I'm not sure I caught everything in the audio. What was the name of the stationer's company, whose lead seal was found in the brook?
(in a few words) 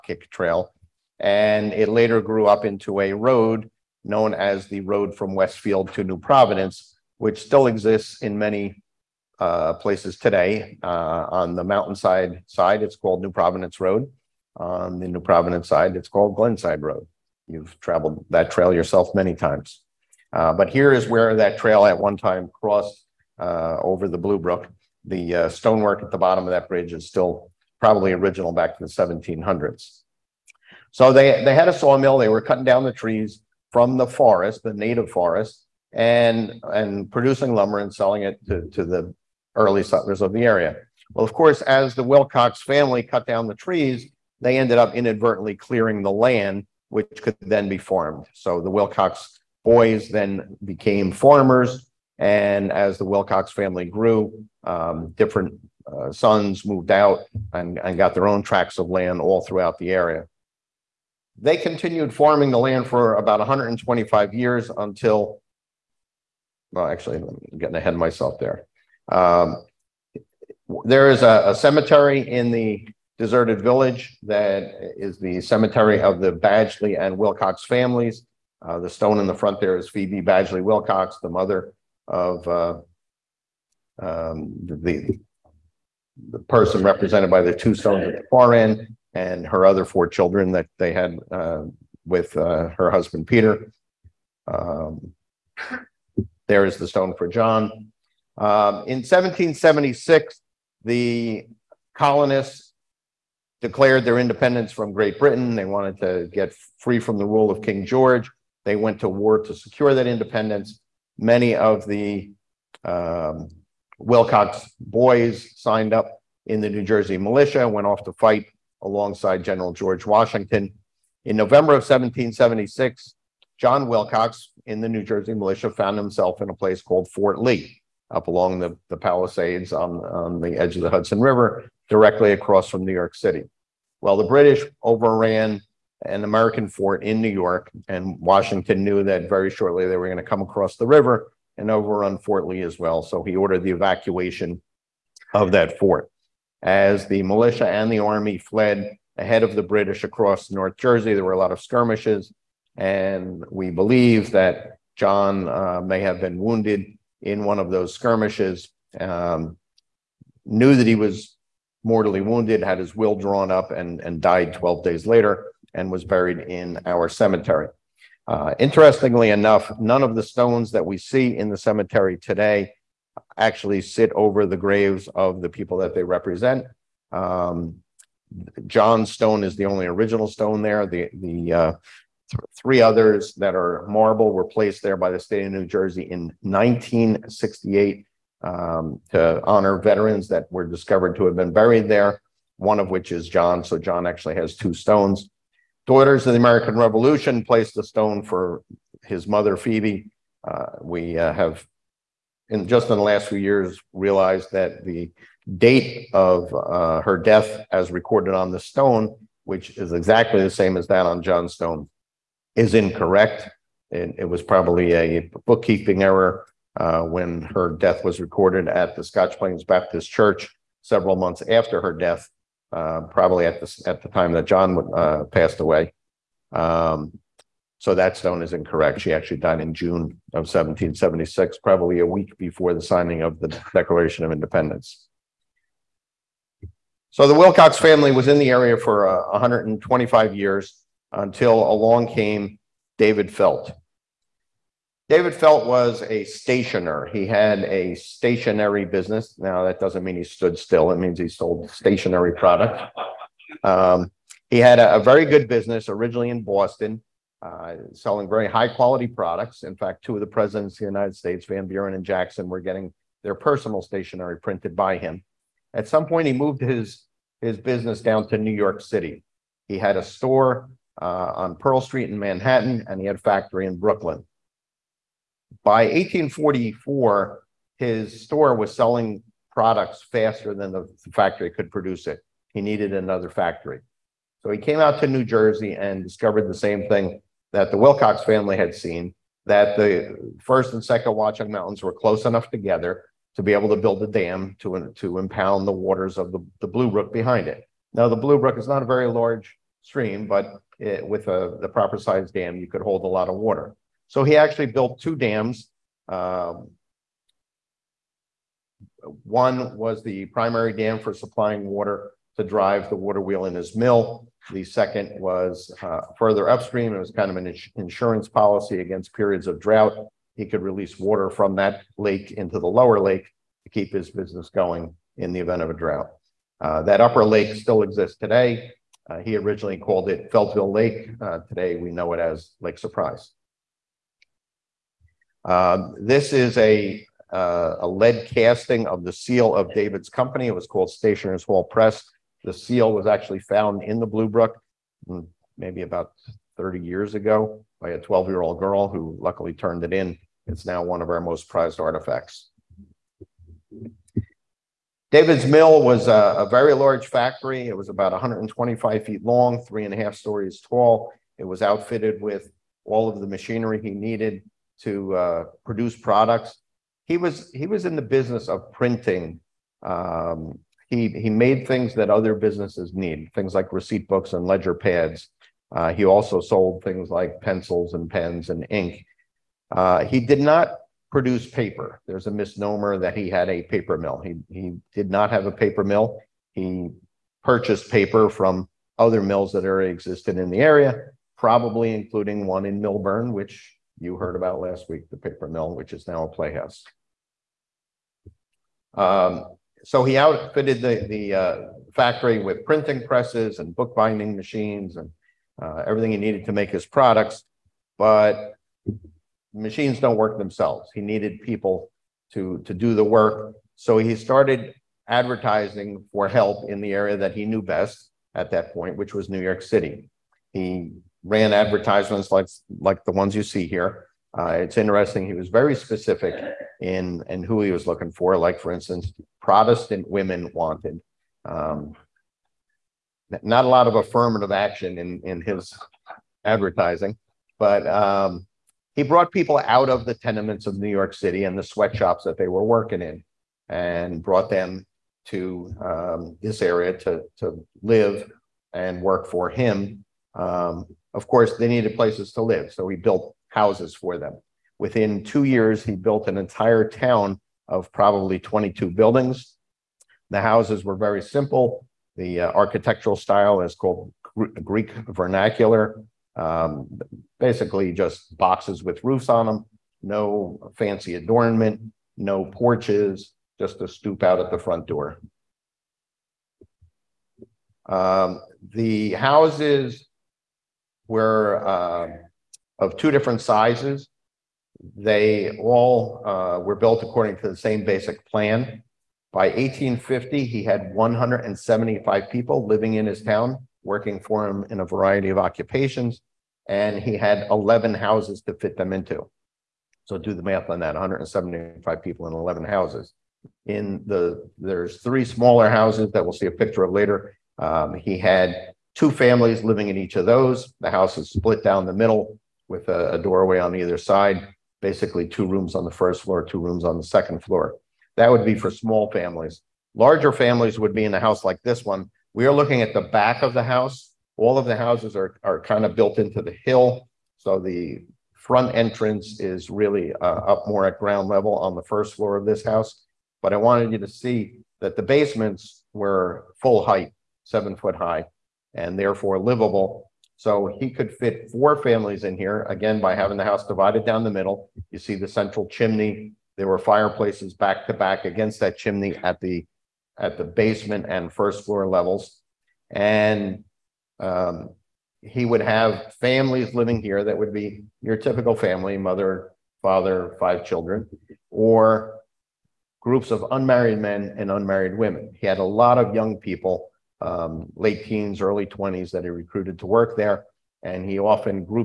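Stationers Hall Press.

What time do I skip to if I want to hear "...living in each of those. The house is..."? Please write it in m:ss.
8:29.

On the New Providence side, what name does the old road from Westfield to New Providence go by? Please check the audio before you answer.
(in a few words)
Glenside Road.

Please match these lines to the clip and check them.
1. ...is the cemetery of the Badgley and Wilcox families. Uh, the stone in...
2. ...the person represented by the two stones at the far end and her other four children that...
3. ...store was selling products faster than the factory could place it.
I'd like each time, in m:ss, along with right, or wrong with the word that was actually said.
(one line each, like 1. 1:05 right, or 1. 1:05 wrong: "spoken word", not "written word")
1. 1:14 right
2. 1:26 right
3. 4:38 wrong: "produce", not "place".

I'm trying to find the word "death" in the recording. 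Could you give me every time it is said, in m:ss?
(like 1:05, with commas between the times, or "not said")
3:27, 3:37, 3:41.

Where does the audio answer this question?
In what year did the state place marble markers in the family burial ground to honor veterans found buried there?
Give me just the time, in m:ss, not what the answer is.
3:06.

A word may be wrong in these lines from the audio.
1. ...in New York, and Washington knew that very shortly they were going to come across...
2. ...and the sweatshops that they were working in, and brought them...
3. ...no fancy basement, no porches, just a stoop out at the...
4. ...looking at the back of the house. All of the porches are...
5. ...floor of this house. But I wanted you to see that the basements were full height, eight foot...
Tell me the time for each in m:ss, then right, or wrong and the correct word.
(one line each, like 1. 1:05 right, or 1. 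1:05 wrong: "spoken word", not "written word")
1. 2:17 right
2. 7:21 right
3. 7:50 wrong: "adornment", not "basement"
4. 8:42 wrong: "houses", not "porches"
5. 8:52 wrong: "seven", not "eight".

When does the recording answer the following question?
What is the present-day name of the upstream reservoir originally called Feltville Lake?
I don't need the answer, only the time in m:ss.
5:32.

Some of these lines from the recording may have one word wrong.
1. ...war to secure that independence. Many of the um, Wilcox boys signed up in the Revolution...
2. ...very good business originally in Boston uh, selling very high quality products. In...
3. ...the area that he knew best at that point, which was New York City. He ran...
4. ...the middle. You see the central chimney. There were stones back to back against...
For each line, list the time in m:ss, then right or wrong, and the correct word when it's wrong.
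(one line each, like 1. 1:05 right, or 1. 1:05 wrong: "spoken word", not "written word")
1. 1:49 wrong: "New", not "Revolution"
2. 4:14 right
3. 6:56 right
4. 9:04 wrong: "fireplaces", not "stones".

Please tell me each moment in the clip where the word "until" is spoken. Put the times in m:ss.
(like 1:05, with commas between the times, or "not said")
1:04, 4:01.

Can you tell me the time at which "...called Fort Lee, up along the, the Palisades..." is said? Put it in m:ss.
2:06.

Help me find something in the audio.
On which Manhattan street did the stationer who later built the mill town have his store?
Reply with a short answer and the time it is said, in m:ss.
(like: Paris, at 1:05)
Pearl Street, at 4:31.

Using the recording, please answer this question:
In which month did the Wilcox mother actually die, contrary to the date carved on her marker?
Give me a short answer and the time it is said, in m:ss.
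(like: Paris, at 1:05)
June, at 3:49.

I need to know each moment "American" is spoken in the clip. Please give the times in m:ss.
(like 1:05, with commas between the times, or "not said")
2:16, 3:16.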